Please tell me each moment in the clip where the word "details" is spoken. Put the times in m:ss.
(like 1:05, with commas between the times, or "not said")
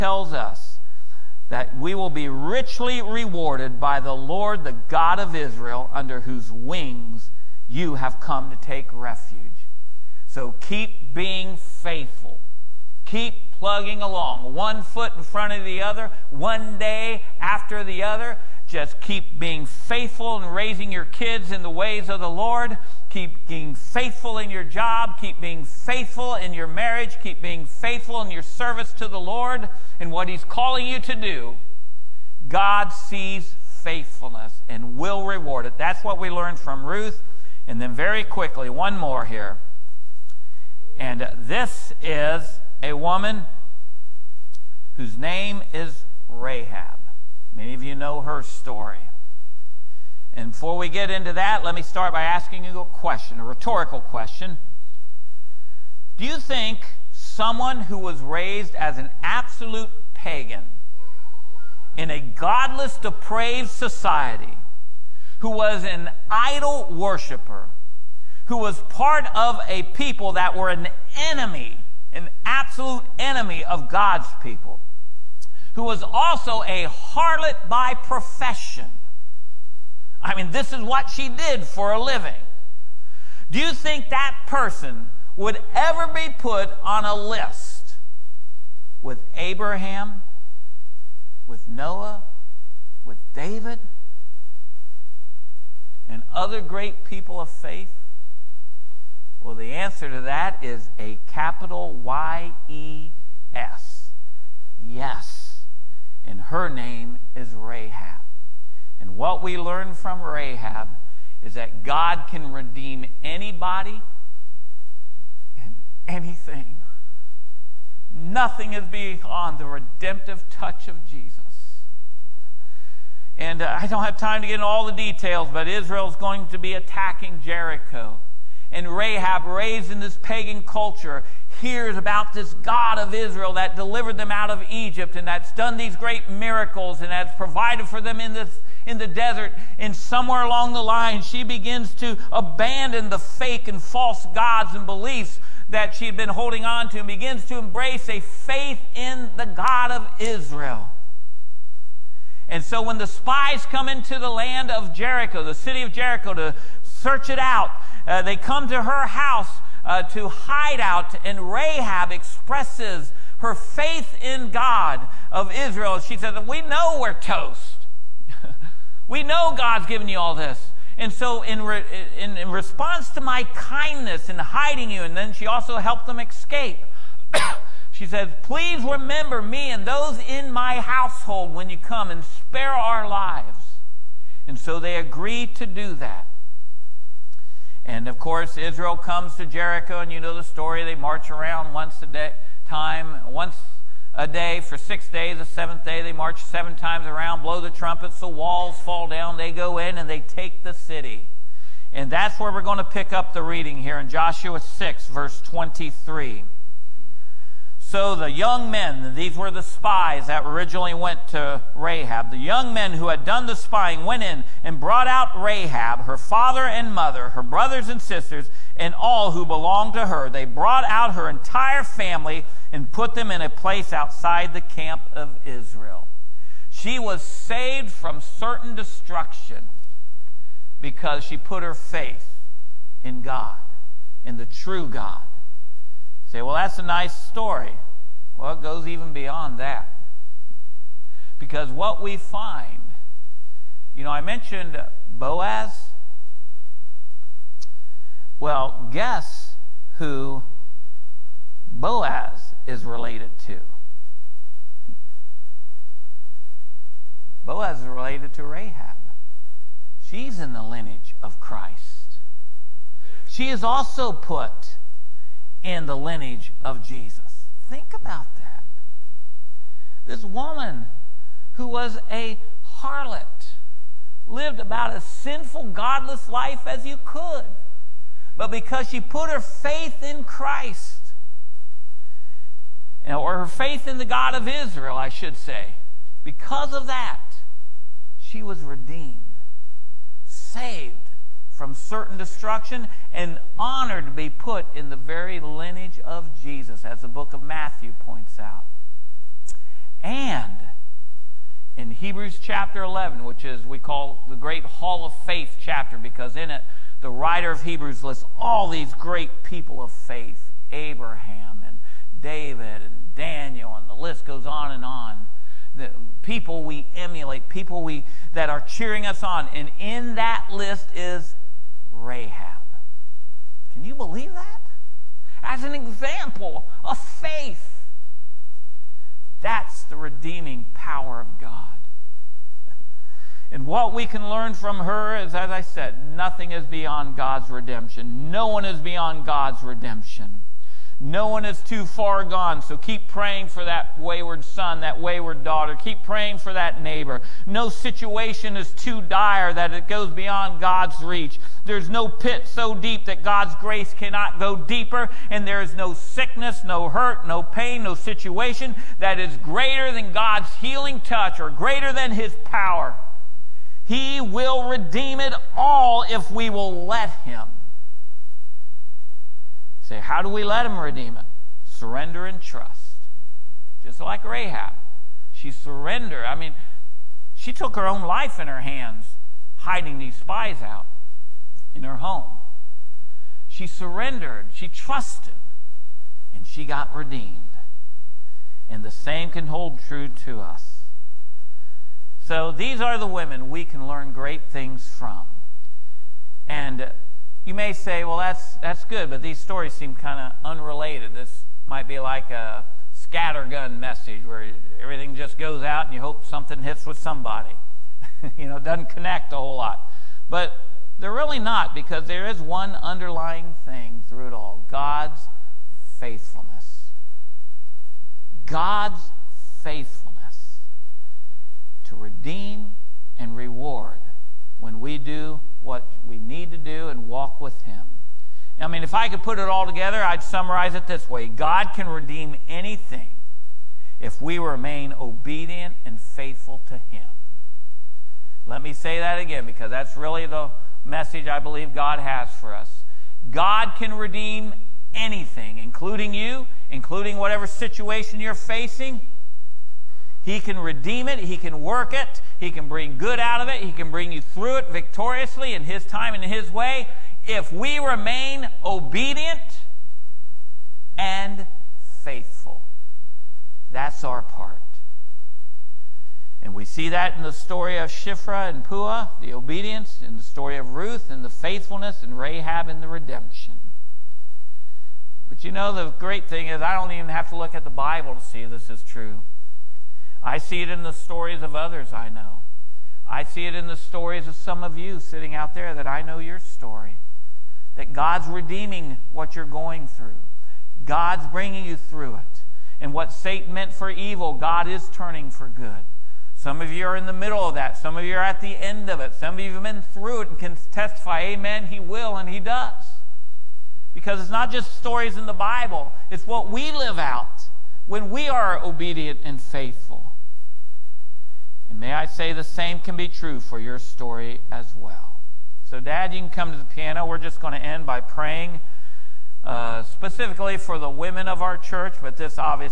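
2:04.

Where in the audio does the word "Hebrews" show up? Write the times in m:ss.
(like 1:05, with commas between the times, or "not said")
5:01, 5:07.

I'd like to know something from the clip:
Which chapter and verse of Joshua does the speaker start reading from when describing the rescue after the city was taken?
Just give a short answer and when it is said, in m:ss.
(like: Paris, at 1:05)
Joshua 6:23, at 3:24.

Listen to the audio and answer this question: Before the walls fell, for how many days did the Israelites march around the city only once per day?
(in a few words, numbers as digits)
6.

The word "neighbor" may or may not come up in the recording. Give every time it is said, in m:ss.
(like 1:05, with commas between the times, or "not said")
5:46.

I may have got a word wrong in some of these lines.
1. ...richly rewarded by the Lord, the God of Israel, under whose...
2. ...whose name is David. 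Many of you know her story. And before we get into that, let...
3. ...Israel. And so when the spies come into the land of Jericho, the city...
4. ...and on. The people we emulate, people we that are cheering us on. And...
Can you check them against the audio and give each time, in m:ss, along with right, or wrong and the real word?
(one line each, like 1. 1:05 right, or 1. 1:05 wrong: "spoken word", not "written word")
1. 0:02 right
2. 0:44 wrong: "Rahab", not "David"
3. 2:30 right
4. 5:14 right.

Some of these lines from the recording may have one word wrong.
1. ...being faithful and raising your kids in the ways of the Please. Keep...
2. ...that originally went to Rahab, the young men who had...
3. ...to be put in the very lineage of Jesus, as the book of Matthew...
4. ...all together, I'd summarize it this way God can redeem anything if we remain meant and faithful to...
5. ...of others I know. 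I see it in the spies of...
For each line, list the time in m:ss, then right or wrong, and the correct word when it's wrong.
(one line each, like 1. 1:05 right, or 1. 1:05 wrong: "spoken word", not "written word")
1. 0:19 wrong: "Lord", not "Please"
2. 3:30 right
3. 4:54 right
4. 7:09 wrong: "obedient", not "meant"
5. 8:01 wrong: "stories", not "spies".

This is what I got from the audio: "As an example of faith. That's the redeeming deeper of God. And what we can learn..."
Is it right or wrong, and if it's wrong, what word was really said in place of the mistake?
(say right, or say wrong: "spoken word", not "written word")
wrong: "power", not "deeper".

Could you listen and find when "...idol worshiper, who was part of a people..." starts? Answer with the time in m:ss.
1:06.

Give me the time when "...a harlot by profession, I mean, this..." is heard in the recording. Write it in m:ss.
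1:16.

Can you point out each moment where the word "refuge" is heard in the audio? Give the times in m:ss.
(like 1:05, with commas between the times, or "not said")
0:08.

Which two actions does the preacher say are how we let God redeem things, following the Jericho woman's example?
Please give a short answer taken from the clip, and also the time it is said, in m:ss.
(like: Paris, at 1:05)
Surrender and trust, at 6:11.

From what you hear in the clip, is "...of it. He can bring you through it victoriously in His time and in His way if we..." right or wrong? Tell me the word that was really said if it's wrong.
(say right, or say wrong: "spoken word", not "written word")
right.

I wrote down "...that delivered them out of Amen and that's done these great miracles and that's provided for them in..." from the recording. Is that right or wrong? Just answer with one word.
wrong.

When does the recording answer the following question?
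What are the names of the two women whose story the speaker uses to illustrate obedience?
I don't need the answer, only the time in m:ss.
7:47.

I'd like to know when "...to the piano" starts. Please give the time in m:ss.
8:36.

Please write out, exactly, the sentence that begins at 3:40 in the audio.
They brought out her entire family and put them in a place outside the camp of Israel.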